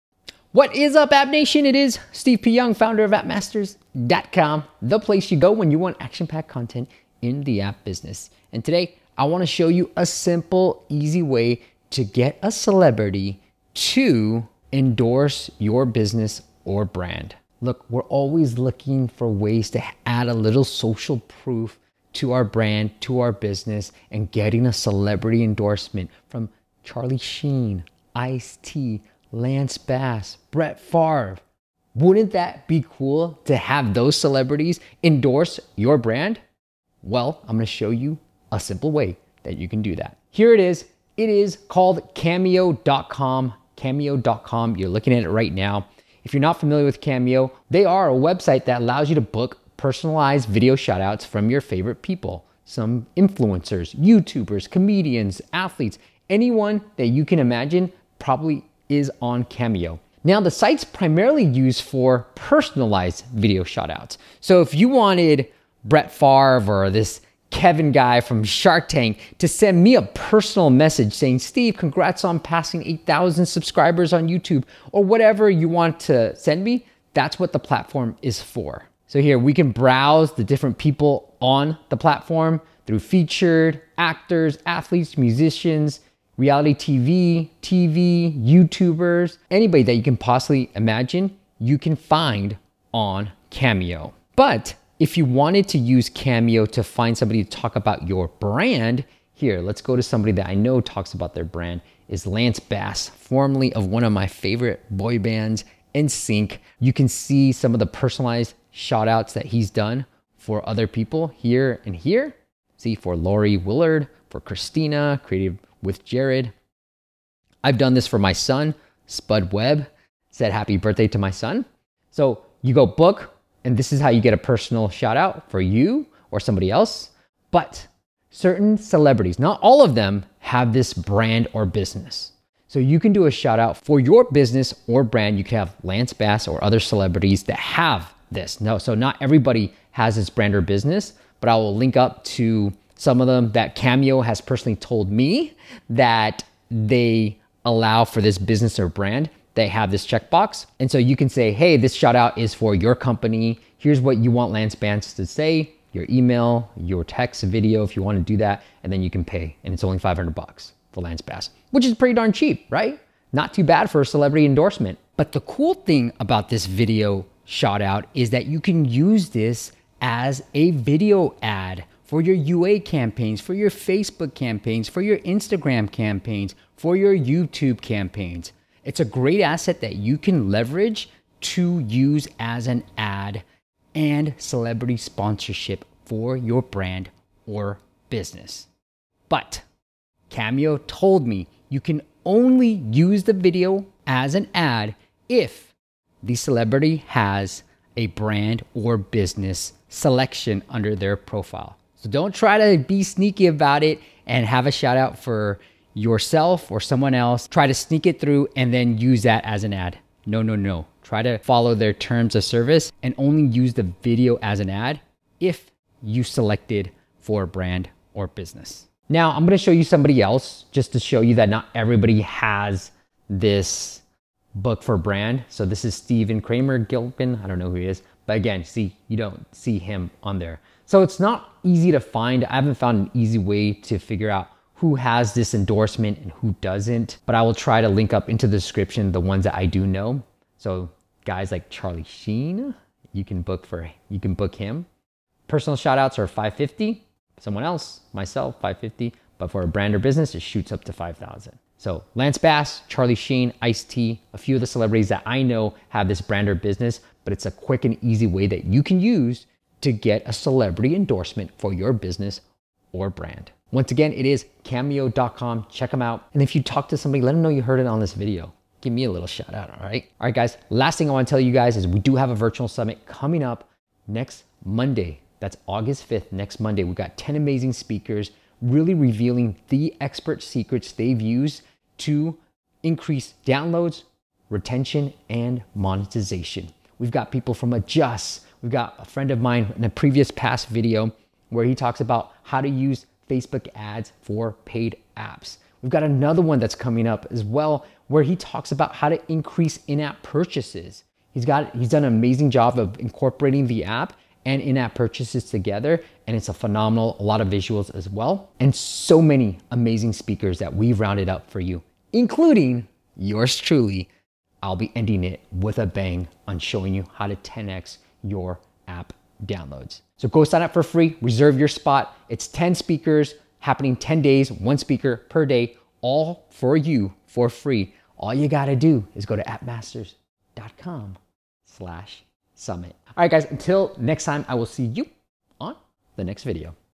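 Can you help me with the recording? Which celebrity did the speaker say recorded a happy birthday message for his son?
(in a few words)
Spud Webb.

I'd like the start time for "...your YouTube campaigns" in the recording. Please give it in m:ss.
2:56.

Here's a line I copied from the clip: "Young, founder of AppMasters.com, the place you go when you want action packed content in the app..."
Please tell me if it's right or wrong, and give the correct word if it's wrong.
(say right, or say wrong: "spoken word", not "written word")
right.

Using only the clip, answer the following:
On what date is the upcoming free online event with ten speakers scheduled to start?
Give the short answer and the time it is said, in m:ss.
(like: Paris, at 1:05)
August 5th, at 4:35.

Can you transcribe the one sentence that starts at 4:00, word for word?
So guys like Charlie Sheen, you can book for you can book him.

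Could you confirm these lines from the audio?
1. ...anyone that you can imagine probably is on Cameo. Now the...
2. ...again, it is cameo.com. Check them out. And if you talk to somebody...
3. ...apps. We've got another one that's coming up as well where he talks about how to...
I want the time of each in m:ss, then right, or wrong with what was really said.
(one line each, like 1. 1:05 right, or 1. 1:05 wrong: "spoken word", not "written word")
1. 0:56 right
2. 4:23 right
3. 4:55 right.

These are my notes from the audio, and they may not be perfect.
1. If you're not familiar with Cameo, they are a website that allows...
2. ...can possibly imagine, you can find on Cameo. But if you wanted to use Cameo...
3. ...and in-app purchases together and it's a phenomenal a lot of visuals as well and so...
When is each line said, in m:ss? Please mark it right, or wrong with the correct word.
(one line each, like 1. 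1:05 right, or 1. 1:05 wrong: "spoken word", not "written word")
1. 0:46 right
2. 1:30 right
3. 5:04 right.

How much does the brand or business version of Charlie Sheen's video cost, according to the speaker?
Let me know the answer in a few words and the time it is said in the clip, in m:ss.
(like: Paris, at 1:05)
5000, at 4:10.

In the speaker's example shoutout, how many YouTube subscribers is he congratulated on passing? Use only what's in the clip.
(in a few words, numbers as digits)
8,000.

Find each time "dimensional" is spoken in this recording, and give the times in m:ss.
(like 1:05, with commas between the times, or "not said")
not said.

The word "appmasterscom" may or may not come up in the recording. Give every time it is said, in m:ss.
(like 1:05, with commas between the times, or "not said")
0:03, 5:29.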